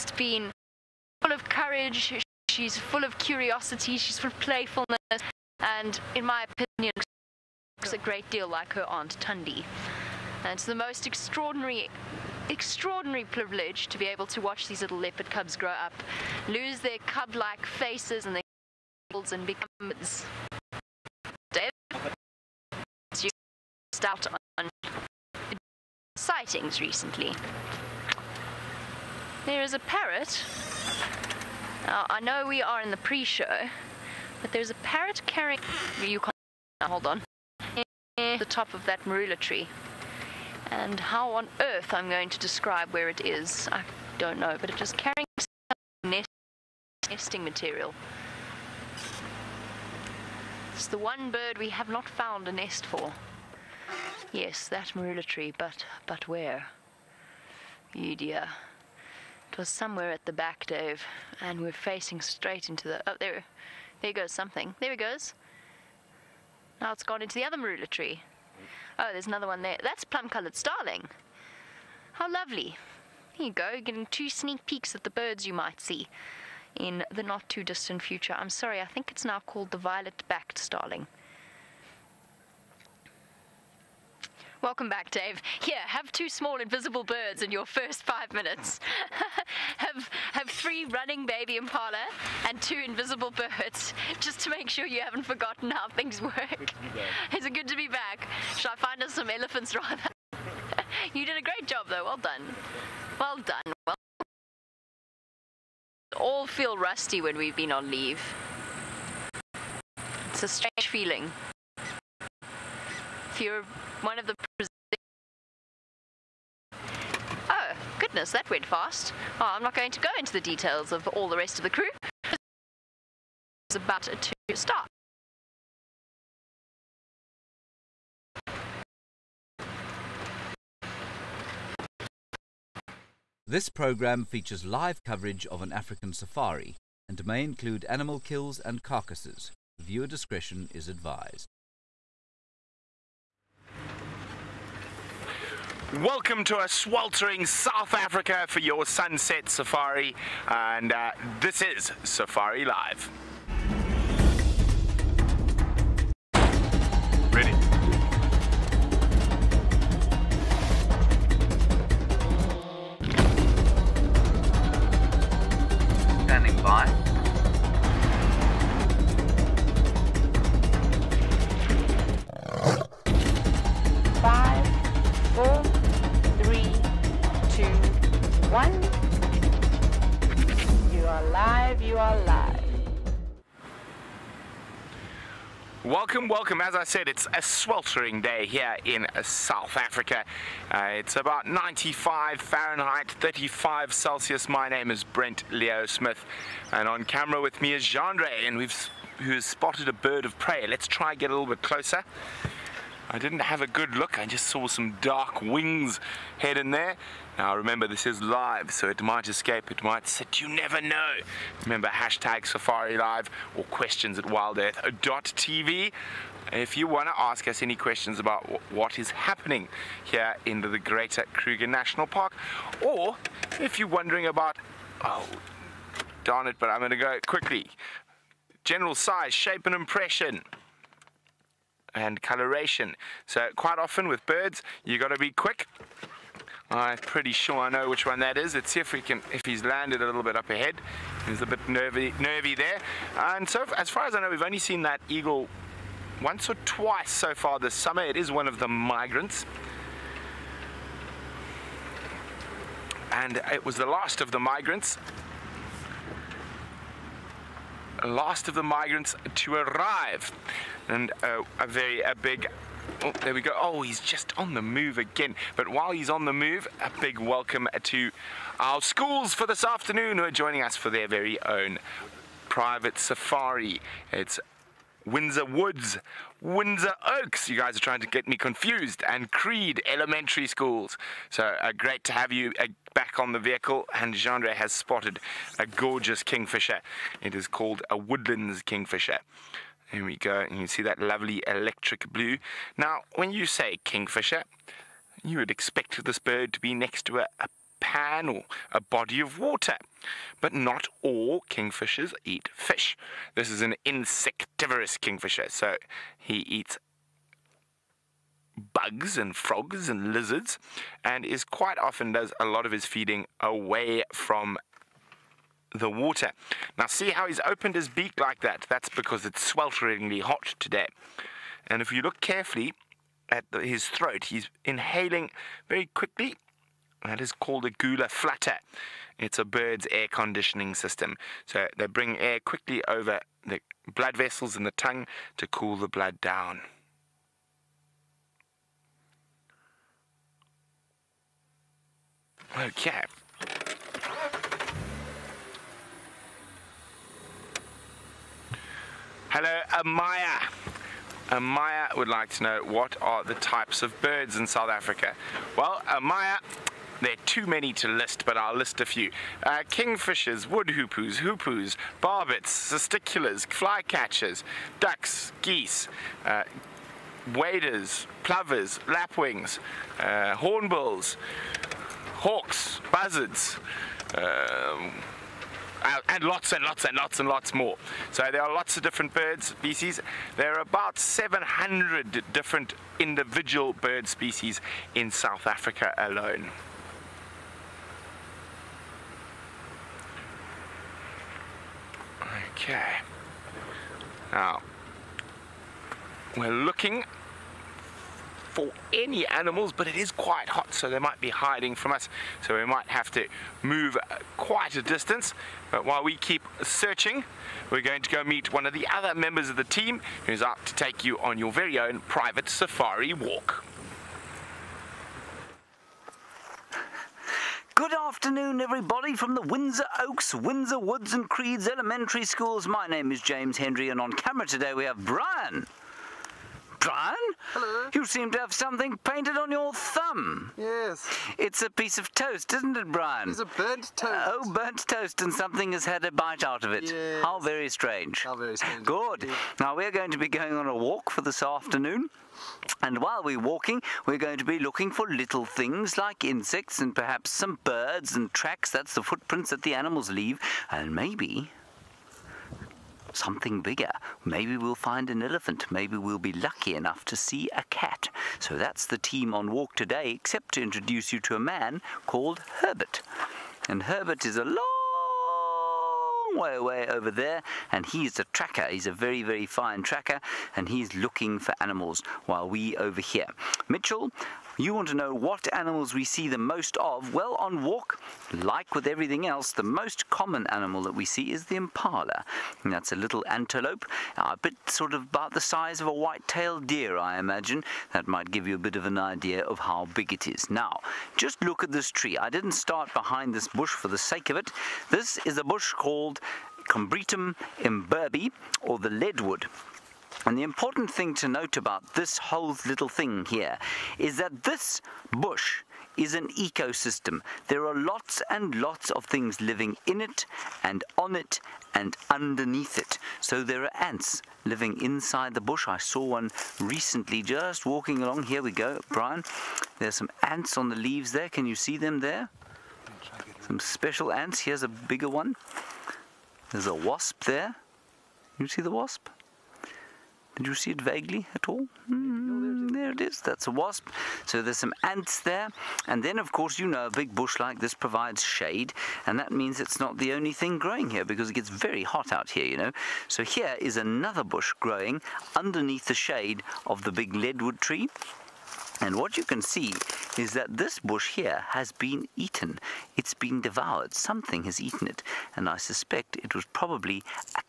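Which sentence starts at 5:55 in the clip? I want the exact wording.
Well, Amaya, there are too many to list, but I'll list a few.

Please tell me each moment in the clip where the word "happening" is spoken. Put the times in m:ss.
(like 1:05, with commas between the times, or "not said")
3:39.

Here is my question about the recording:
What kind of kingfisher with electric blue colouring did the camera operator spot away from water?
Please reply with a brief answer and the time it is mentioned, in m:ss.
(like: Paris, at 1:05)
Woodlands kingfisher, at 4:47.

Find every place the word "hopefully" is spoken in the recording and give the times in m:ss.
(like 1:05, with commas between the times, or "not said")
not said.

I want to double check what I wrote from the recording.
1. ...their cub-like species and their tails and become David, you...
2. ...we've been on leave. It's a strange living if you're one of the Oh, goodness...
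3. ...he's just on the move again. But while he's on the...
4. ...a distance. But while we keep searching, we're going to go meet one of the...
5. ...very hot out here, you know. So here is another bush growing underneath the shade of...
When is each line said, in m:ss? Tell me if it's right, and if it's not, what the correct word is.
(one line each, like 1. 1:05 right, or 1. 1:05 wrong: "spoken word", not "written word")
1. 0:16 wrong: "faces", not "species"
2. 1:47 wrong: "feeling", not "living"
3. 4:23 right
4. 6:44 right
5. 9:01 right.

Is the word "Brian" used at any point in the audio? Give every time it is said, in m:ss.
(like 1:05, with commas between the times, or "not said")
7:05, 7:12, 8:38.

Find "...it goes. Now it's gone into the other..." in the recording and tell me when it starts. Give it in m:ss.
1:04.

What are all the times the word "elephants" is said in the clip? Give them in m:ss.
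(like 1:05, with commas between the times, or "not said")
1:39, 7:35.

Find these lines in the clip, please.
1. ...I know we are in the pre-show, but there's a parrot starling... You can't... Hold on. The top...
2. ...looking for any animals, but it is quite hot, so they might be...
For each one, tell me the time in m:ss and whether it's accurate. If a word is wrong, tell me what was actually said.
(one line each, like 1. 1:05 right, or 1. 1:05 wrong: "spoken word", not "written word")
1. 0:32 wrong: "carrying", not "starling"
2. 6:36 right.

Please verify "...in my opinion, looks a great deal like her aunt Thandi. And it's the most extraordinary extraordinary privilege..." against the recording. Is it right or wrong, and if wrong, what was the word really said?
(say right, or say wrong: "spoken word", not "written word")
right.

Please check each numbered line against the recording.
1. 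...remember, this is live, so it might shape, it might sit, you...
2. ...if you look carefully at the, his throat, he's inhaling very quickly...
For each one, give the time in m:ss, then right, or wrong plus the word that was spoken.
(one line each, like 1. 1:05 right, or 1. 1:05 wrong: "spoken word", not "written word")
1. 3:27 wrong: "escape", not "shape"
2. 5:21 right.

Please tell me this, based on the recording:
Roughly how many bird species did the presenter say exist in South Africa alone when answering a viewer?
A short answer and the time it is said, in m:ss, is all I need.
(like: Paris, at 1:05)
700, at 6:20.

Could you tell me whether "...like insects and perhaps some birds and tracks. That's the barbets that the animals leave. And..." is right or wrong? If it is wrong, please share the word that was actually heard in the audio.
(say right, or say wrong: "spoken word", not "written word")
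wrong: "footprints", not "barbets".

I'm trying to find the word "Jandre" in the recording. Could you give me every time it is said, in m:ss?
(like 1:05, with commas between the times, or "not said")
3:17, 4:44.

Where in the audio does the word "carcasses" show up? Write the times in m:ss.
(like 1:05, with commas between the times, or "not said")
2:18.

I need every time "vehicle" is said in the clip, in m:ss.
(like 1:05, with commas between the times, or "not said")
4:43.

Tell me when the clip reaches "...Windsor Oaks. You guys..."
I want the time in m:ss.
4:36.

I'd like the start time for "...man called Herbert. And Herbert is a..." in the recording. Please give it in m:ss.
7:41.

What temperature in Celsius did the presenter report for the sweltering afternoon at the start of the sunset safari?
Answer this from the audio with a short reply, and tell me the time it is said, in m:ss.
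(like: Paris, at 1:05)
35, at 3:13.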